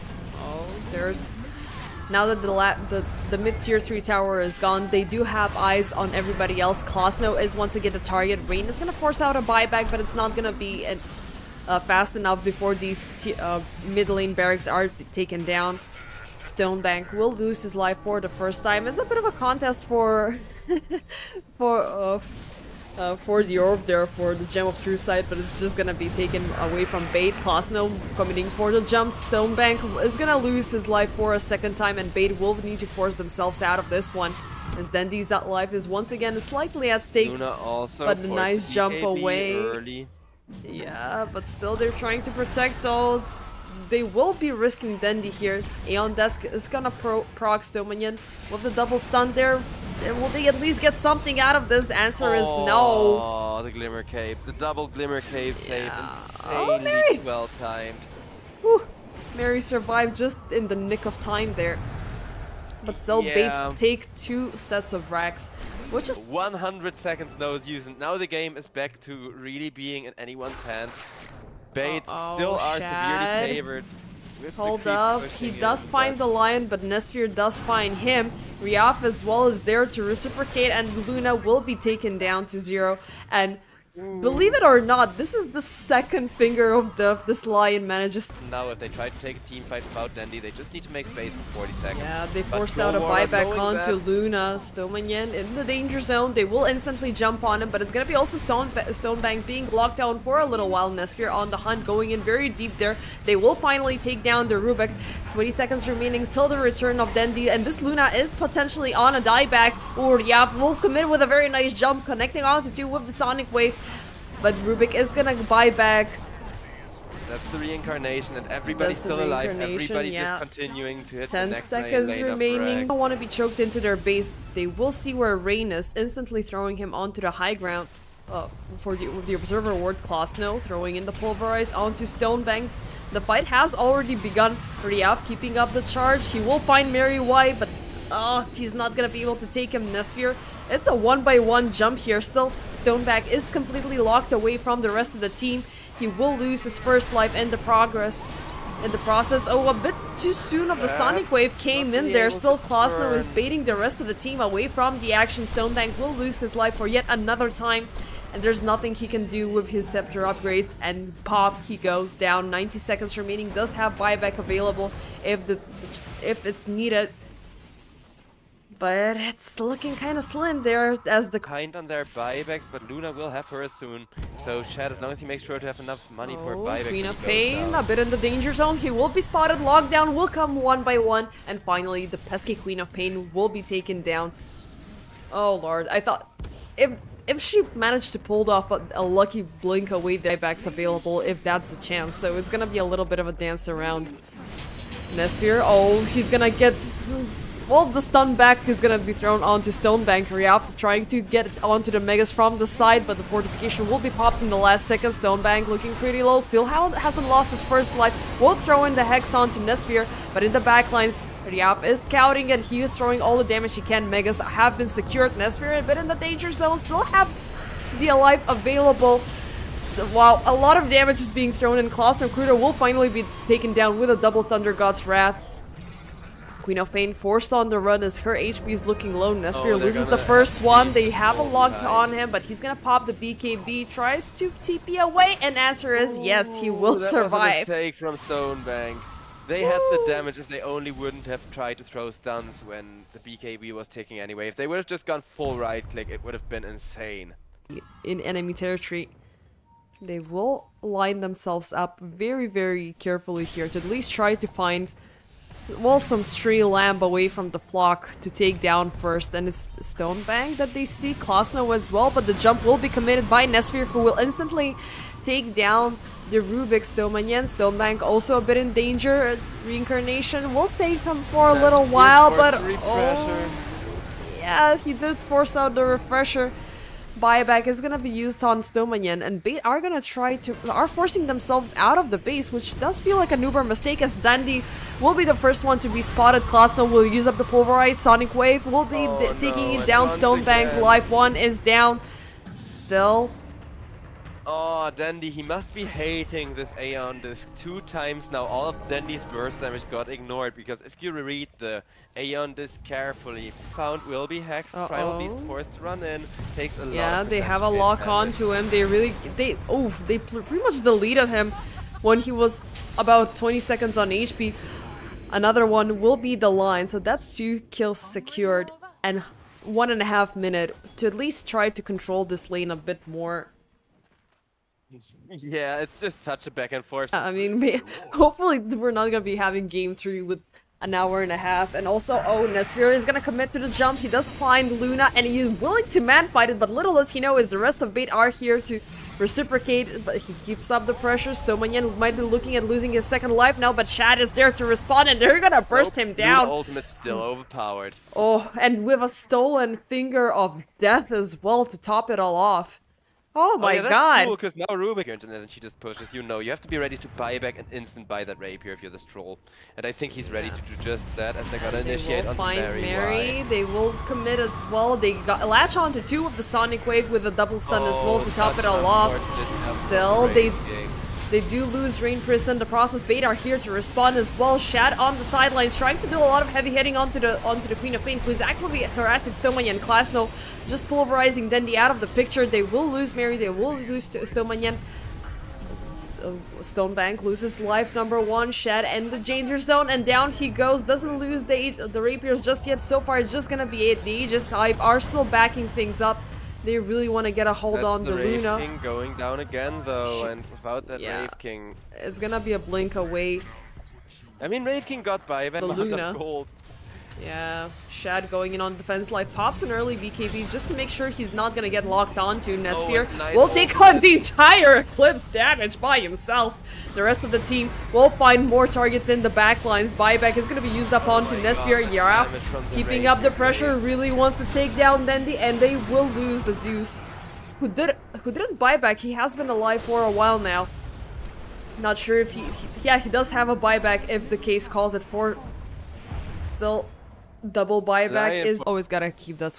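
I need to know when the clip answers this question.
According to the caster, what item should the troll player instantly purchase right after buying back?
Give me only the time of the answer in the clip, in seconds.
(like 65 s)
358 s.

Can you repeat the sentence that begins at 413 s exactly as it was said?
Oh, nice will take on the entire Eclipse damage by himself.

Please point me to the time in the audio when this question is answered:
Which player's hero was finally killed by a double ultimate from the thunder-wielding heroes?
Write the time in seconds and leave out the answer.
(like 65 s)
221 s.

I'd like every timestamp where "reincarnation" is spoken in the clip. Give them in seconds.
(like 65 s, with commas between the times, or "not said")
117 s, 269 s.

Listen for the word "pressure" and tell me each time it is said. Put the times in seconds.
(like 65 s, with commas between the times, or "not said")
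340 s, 423 s.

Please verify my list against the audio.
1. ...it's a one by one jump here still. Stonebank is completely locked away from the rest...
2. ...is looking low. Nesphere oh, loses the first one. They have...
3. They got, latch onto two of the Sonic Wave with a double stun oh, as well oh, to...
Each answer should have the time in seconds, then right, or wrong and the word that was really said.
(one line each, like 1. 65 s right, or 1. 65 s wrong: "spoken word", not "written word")
1. 140 s right
2. 228 s right
3. 364 s right.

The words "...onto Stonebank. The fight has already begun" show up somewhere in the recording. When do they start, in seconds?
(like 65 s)
131 s.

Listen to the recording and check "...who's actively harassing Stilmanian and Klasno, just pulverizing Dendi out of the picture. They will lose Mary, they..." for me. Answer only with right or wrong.
right.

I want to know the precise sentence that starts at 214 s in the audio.
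Megas have been secured, Nesphere but in the danger zone, still has the alive available.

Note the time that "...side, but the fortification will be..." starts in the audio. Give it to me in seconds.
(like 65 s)
202 s.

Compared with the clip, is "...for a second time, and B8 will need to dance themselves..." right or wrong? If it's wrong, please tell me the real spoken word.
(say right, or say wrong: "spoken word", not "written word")
wrong: "force", not "dance".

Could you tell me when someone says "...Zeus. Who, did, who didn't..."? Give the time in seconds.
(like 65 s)
426 s.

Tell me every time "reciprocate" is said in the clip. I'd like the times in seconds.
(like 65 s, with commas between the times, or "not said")
80 s, 339 s.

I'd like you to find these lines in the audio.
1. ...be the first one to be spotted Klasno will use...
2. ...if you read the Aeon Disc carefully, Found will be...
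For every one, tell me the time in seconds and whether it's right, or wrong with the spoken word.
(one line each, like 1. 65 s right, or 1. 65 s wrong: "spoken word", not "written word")
1. 285 s right
2. 300 s right.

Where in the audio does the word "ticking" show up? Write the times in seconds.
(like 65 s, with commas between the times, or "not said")
243 s.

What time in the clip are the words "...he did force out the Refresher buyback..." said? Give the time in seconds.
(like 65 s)
274 s.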